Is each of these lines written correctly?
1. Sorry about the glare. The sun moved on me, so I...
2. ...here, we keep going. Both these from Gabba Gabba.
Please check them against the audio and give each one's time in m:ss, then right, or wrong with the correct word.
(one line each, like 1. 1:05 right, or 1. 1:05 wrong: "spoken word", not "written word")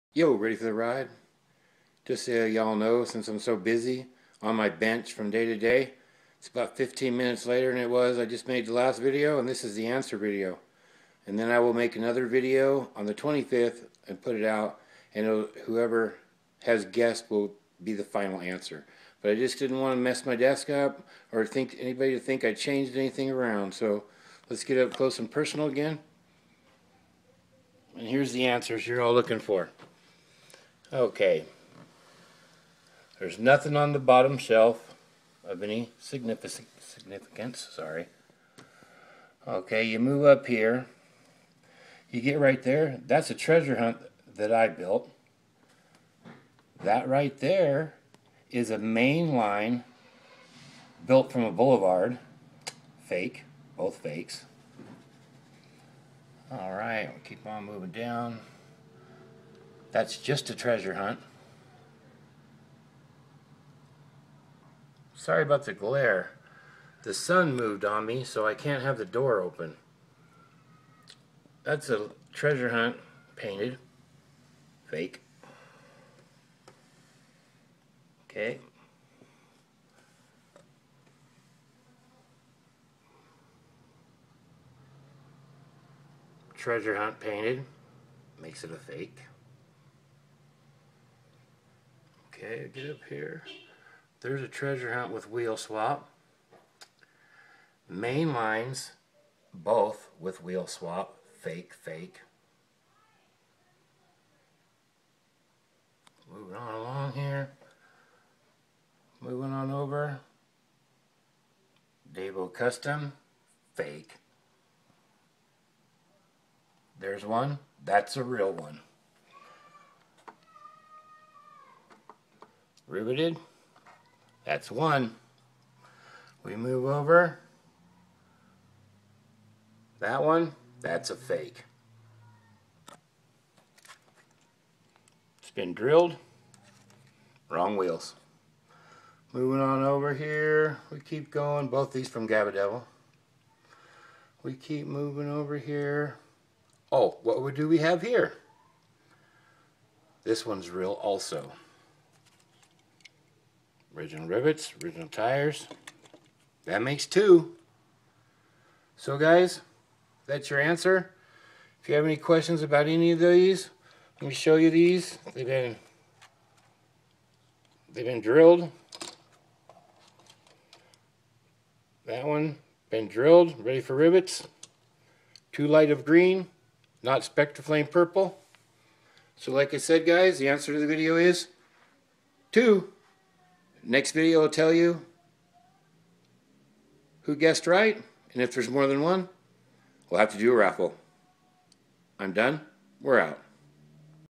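1. 1:05 right
2. 2:20 wrong: "Devil", not "Gabba".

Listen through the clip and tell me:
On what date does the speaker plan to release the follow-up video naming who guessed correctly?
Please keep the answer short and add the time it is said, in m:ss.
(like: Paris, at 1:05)
the 25th, at 0:13.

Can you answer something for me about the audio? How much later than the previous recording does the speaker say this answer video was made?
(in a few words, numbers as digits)
15 minutes.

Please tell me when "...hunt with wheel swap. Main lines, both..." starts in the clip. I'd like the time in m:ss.
1:34.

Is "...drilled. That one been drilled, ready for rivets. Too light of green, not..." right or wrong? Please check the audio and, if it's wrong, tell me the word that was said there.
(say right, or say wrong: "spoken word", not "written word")
right.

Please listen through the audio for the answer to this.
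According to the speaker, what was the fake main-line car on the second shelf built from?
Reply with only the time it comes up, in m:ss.
0:51.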